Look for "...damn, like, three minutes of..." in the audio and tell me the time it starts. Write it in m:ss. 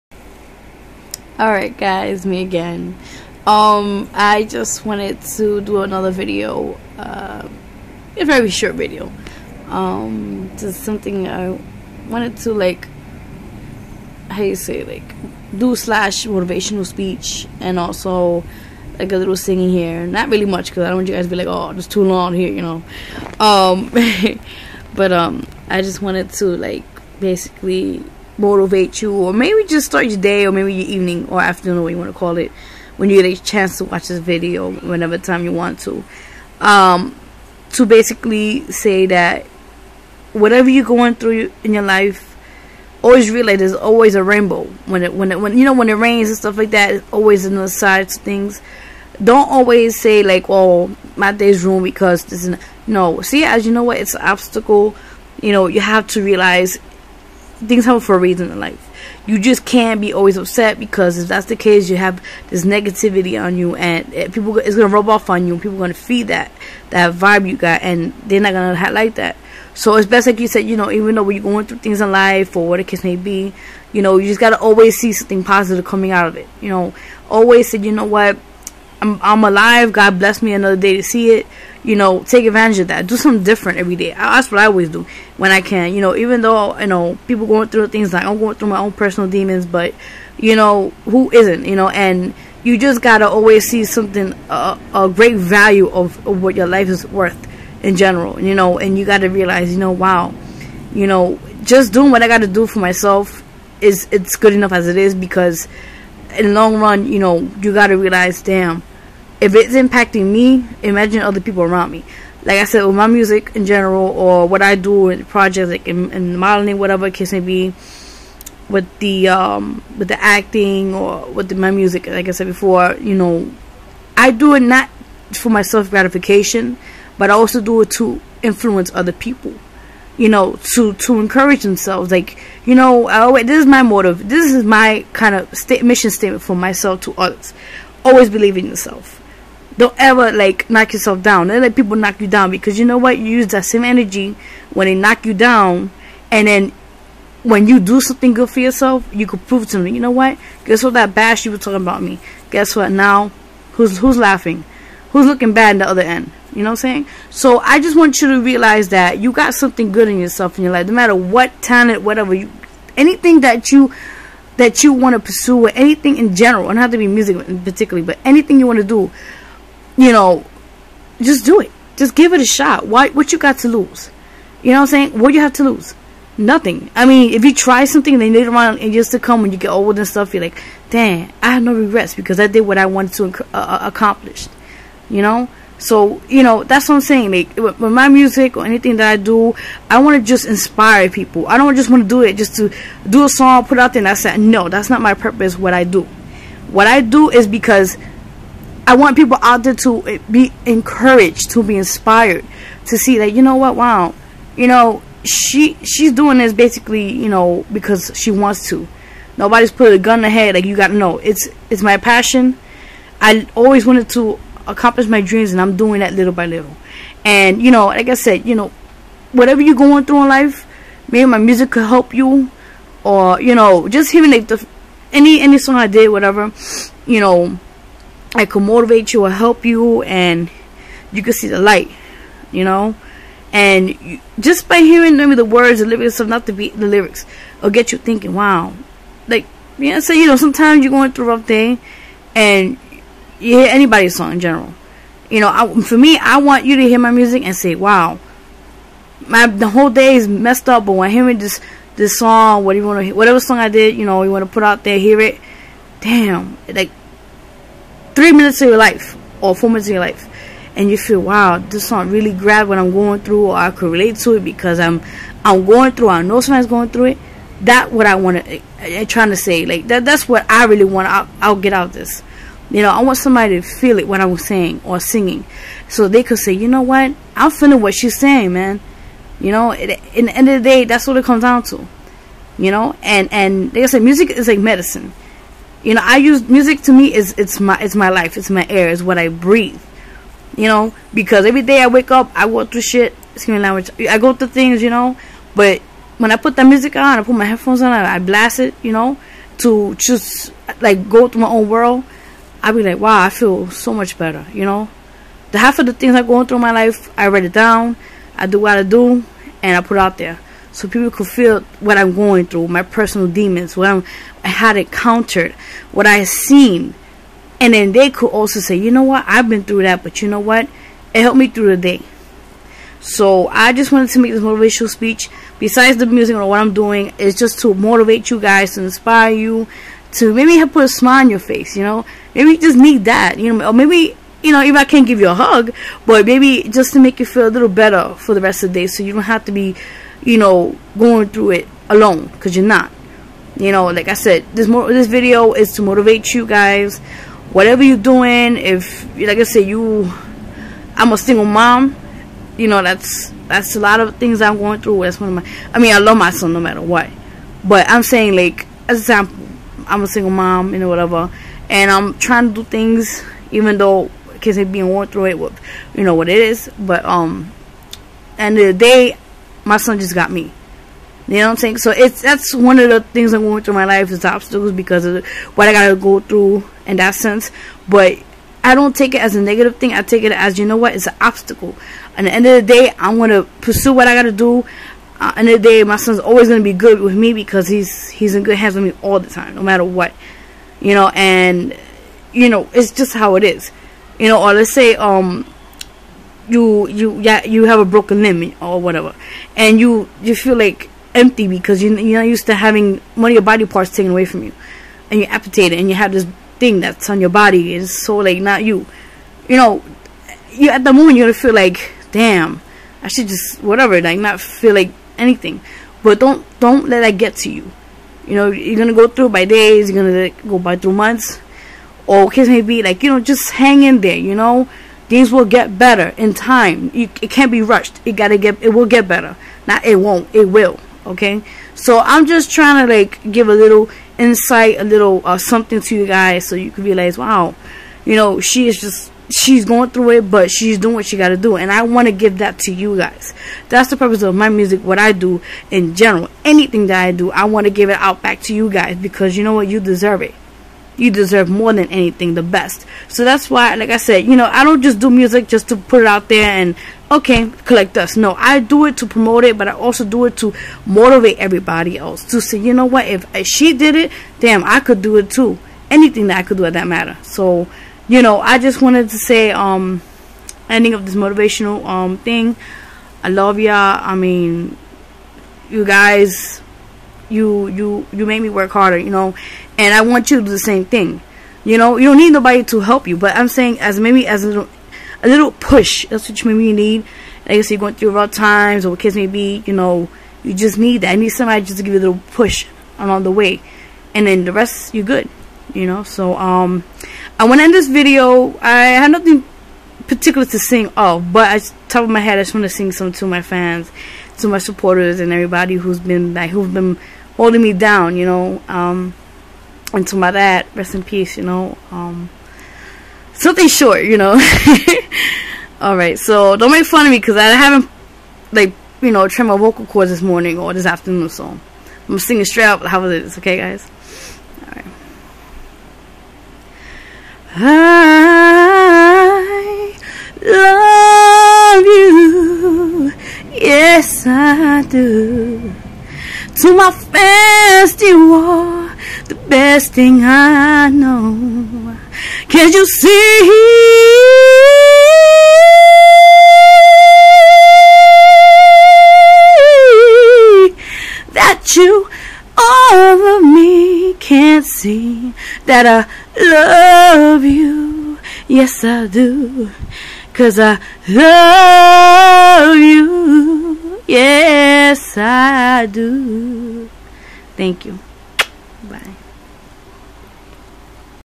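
4:16.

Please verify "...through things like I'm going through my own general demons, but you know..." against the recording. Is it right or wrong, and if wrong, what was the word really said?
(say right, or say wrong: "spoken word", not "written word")
wrong: "personal", not "general".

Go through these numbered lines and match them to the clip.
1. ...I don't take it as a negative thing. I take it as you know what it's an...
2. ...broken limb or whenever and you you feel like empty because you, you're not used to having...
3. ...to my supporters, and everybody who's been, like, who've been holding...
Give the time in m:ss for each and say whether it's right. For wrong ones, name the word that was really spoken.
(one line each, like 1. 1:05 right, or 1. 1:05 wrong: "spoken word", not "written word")
1. 6:18 right
2. 6:37 wrong: "whatever", not "whenever"
3. 8:24 right.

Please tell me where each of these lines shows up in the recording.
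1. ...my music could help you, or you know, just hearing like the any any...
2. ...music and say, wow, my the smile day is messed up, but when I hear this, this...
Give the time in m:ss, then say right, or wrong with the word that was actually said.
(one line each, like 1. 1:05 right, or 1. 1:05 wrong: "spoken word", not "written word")
1. 3:41 right
2. 4:07 wrong: "whole", not "smile".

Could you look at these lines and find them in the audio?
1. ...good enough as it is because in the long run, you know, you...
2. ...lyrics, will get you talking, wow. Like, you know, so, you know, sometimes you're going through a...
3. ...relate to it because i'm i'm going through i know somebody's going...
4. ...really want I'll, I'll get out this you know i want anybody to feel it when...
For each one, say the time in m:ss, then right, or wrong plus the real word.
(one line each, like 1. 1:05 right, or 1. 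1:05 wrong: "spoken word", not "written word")
1. 1:44 right
2. 3:56 wrong: "thinking", not "talking"
3. 4:23 right
4. 4:30 wrong: "somebody", not "anybody".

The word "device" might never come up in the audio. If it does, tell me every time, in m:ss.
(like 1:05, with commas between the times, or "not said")
not said.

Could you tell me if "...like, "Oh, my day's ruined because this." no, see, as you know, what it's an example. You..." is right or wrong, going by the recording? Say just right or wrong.
wrong.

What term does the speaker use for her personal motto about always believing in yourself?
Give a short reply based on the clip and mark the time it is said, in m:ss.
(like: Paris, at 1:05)
mission statement, at 2:15.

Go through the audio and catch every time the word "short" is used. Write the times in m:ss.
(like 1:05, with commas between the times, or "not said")
0:08, 8:33.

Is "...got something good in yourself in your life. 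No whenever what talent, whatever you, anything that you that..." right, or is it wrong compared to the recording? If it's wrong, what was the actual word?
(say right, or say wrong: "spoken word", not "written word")
wrong: "matter", not "whenever".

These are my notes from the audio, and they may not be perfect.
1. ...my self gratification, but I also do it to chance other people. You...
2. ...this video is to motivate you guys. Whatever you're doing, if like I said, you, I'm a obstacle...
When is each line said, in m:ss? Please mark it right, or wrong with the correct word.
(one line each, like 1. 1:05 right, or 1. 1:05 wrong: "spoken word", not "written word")
1. 2:05 wrong: "influence", not "chance"
2. 5:44 wrong: "single", not "obstacle".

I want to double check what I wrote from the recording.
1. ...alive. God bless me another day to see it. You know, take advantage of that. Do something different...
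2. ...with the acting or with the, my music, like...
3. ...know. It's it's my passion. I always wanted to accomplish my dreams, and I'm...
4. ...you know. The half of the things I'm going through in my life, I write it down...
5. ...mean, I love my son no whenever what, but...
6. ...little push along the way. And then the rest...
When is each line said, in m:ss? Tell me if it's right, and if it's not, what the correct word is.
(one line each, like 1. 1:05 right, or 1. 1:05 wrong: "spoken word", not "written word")
1. 1:19 right
2. 1:59 right
3. 3:30 right
4. 5:04 right
5. 5:55 wrong: "matter", not "whenever"
6. 8:12 right.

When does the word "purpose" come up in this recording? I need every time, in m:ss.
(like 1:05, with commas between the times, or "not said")
3:15, 7:23.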